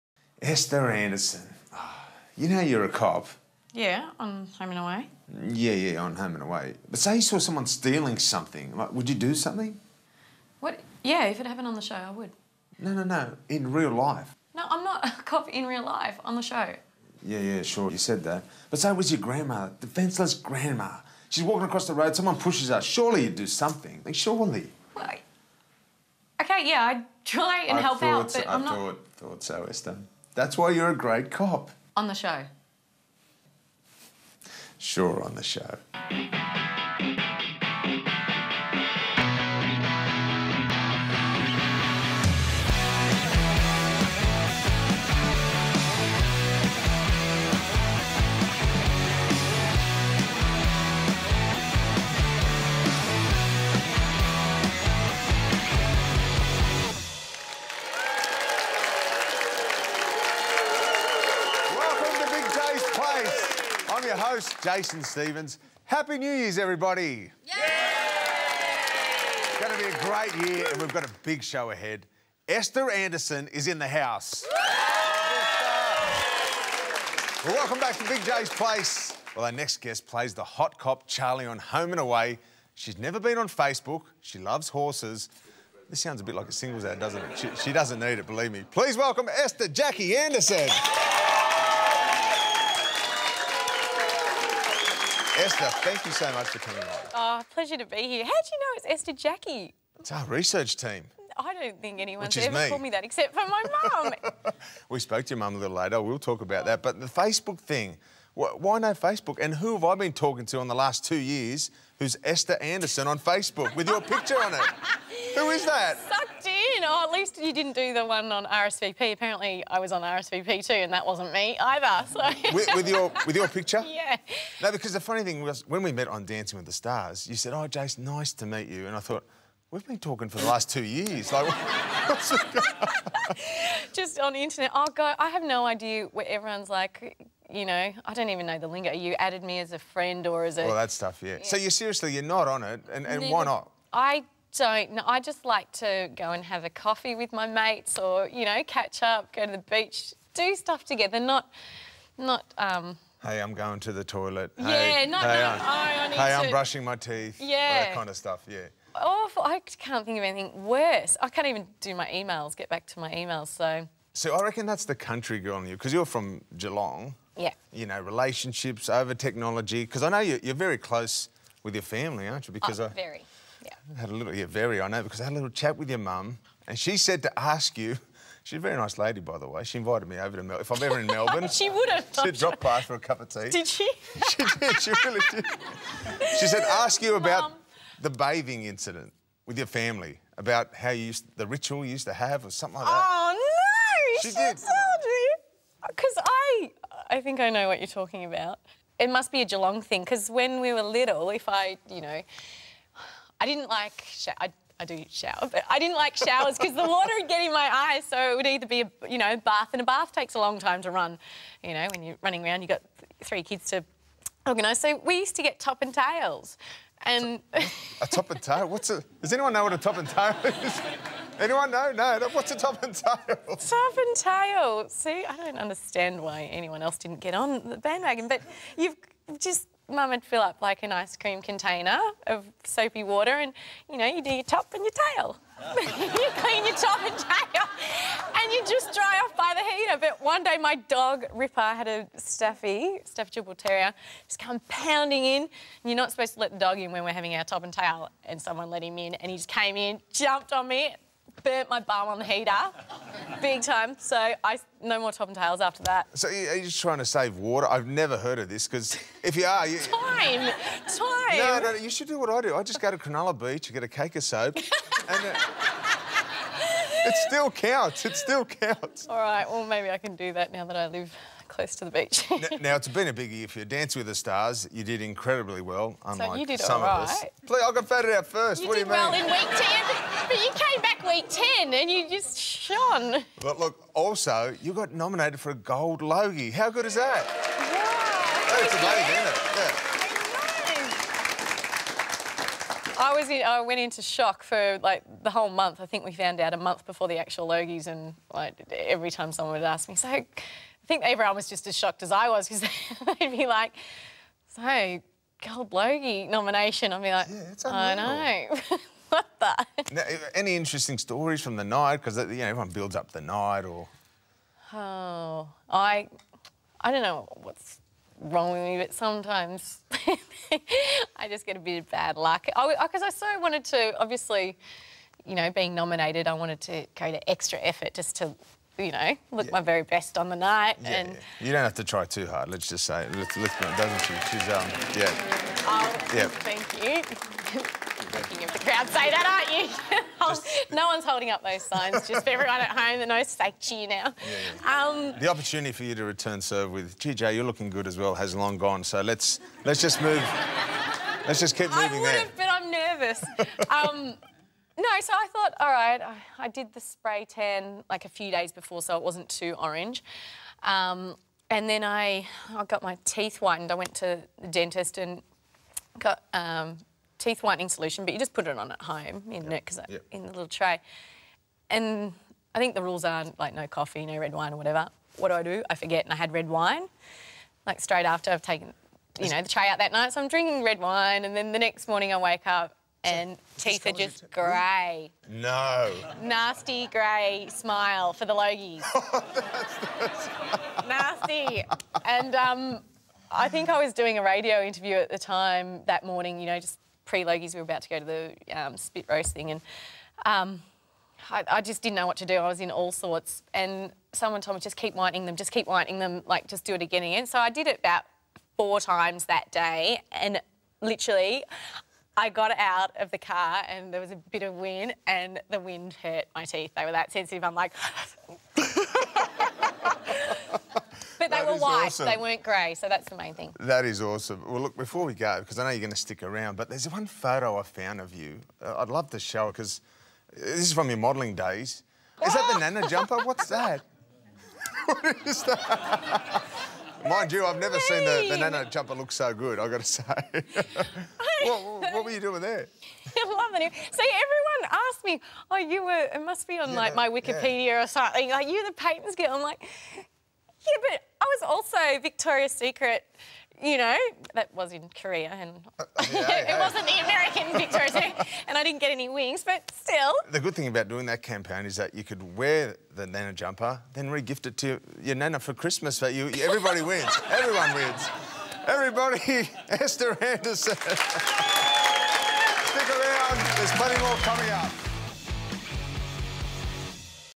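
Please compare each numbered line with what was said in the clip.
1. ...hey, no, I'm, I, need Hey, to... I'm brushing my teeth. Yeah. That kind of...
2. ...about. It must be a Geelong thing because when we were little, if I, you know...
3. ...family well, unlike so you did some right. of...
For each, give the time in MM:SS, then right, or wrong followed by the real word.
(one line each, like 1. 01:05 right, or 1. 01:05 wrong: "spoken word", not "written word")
1. 02:35 right
2. 03:18 right
3. 04:35 wrong: "incredibly", not "family".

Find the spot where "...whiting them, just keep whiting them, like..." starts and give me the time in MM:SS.
06:44.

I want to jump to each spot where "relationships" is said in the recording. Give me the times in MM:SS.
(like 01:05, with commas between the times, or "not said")
02:48.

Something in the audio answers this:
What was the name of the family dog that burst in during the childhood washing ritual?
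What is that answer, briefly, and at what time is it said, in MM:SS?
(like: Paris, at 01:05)
Ripper, at 04:01.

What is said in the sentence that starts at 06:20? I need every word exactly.
So I'm drinking red wine and then the next morning I wake up and so, teeth are just grey.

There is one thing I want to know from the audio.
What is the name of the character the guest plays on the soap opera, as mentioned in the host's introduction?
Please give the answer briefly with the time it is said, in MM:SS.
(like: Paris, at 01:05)
Charlie, at 01:21.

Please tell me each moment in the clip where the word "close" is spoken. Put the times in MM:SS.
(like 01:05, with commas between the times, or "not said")
02:50, 04:31.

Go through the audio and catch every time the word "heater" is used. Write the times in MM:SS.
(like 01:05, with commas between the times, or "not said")
03:59, 04:12.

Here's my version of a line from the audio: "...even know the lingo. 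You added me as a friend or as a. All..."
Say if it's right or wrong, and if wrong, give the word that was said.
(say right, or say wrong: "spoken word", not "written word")
right.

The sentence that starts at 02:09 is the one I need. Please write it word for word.
We've been talking for the last two years.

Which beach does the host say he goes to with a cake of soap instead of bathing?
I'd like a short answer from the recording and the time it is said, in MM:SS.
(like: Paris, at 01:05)
Cronulla Beach, at 04:22.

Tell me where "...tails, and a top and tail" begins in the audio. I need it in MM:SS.
03:35.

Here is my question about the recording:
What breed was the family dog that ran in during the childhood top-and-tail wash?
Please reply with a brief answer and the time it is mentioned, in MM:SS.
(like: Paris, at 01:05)
Staffy Bull Terrier, at 04:03.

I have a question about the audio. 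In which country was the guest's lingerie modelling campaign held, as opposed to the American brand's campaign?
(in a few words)
Korea.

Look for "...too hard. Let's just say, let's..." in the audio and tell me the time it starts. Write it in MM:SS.
05:32.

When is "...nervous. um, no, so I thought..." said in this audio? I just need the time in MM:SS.
05:52.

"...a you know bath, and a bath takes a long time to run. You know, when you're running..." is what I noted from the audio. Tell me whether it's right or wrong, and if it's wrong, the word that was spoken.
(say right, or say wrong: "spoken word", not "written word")
right.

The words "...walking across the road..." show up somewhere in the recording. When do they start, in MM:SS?
00:21.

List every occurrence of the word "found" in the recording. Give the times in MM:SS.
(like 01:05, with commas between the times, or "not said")
04:56, 07:07.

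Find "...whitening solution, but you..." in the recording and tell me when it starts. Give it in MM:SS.
06:07.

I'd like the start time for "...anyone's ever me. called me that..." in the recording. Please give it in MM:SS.
01:41.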